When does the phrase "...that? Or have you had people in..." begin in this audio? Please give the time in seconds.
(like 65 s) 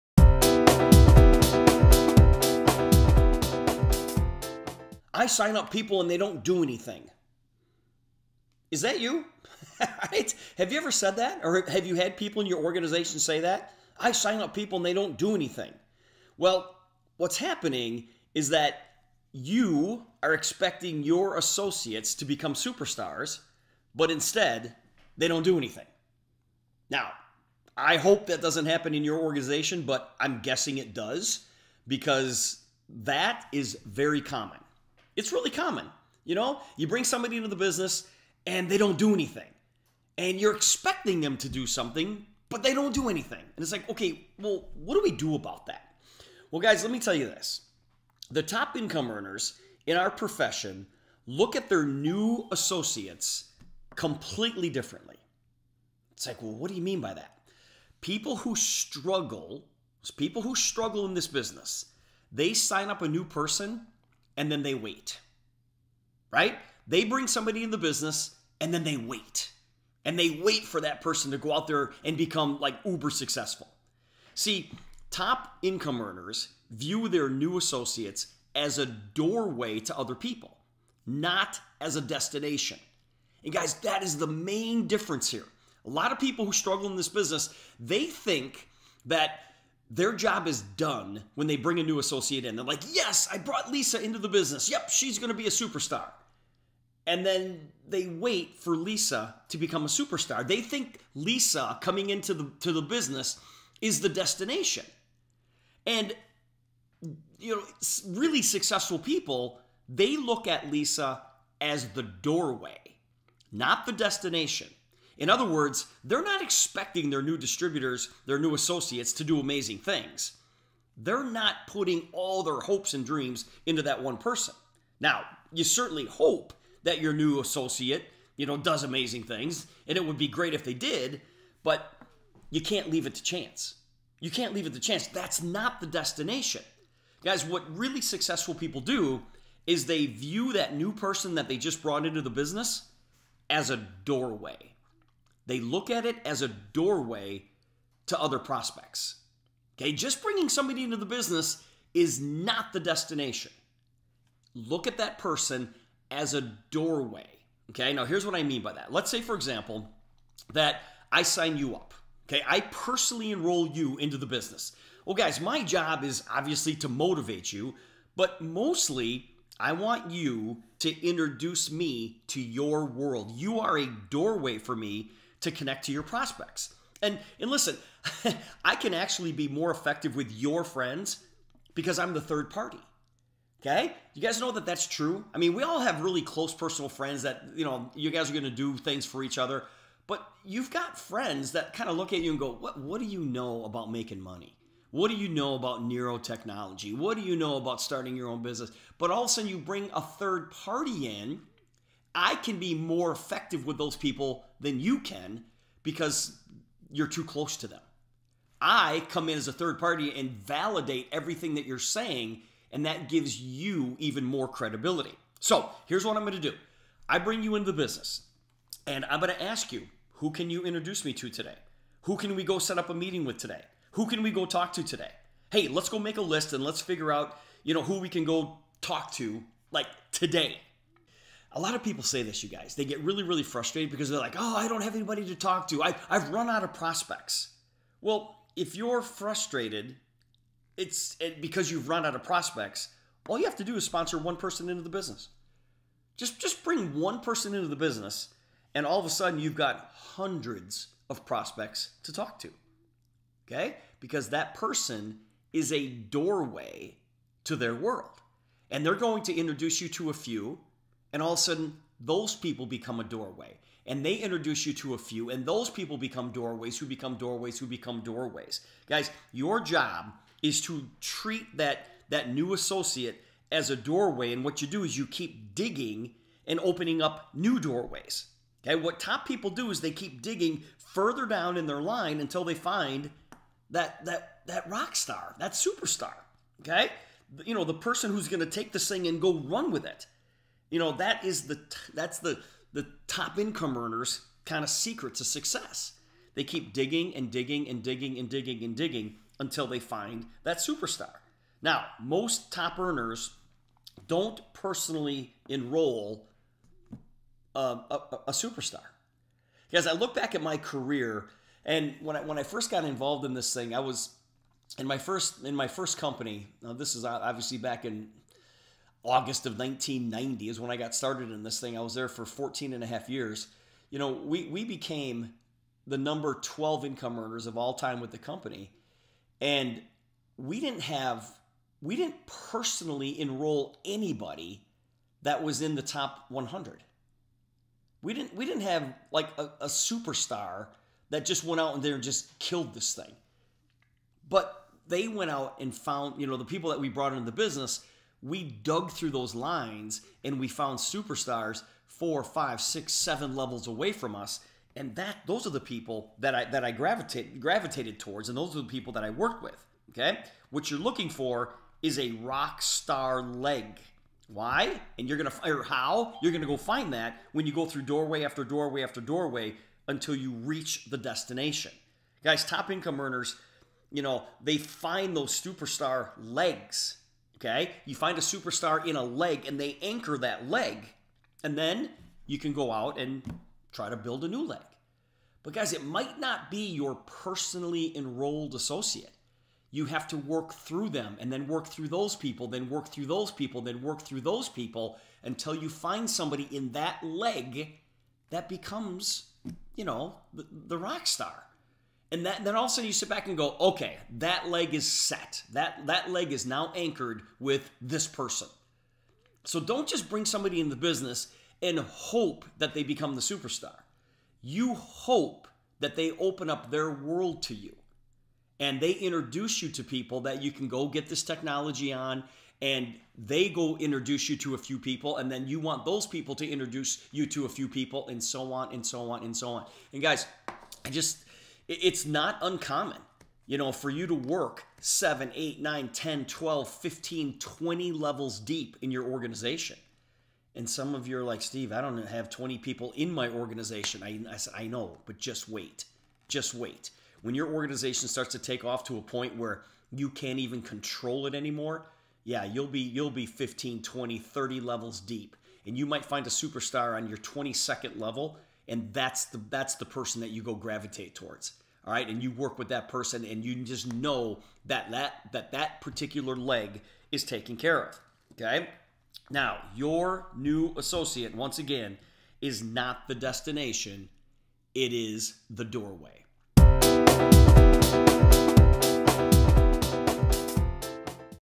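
11 s.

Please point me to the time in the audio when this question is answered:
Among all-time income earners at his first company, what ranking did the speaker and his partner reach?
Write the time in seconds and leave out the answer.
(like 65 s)
325 s.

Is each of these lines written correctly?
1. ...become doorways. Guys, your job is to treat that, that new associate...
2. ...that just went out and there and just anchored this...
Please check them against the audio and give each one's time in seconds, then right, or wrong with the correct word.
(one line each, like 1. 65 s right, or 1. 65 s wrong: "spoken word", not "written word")
1. 267 s right
2. 341 s wrong: "killed", not "anchored".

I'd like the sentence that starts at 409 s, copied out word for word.
So don't just bring somebody in the business and hope that they become the superstar.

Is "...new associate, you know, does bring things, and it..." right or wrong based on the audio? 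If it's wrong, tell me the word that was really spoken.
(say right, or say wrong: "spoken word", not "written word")
wrong: "amazing", not "bring".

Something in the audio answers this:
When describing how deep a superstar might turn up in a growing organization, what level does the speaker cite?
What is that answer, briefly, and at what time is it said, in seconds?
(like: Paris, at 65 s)
22nd level, at 457 s.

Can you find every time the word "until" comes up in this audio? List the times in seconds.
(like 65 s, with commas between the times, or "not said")
282 s, 299 s, 369 s, 395 s.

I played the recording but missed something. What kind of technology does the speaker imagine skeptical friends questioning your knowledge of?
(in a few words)
Neurotechnology.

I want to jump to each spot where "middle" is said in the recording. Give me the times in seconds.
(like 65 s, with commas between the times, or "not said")
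not said.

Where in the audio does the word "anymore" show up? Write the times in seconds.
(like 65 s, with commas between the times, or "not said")
451 s.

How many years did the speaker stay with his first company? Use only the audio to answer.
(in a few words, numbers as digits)
14 and a half.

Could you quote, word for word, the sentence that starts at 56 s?
It's like, well, what do you mean by that?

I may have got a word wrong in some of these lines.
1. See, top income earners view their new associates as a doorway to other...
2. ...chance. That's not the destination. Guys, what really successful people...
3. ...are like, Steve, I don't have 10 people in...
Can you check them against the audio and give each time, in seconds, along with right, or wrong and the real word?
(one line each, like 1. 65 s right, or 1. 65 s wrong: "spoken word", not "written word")
1. 74 s right
2. 134 s right
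3. 441 s wrong: "20", not "10".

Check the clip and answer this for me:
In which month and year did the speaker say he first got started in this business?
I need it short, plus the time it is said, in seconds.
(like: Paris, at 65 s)
August 1990, at 319 s.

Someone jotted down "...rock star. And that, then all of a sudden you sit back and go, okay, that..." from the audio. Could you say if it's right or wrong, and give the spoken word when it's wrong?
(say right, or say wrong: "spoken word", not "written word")
right.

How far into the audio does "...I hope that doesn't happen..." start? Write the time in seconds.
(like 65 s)
27 s.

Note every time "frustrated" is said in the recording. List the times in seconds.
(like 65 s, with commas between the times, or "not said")
233 s, 239 s.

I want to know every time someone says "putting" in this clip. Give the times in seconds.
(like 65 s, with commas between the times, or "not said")
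121 s.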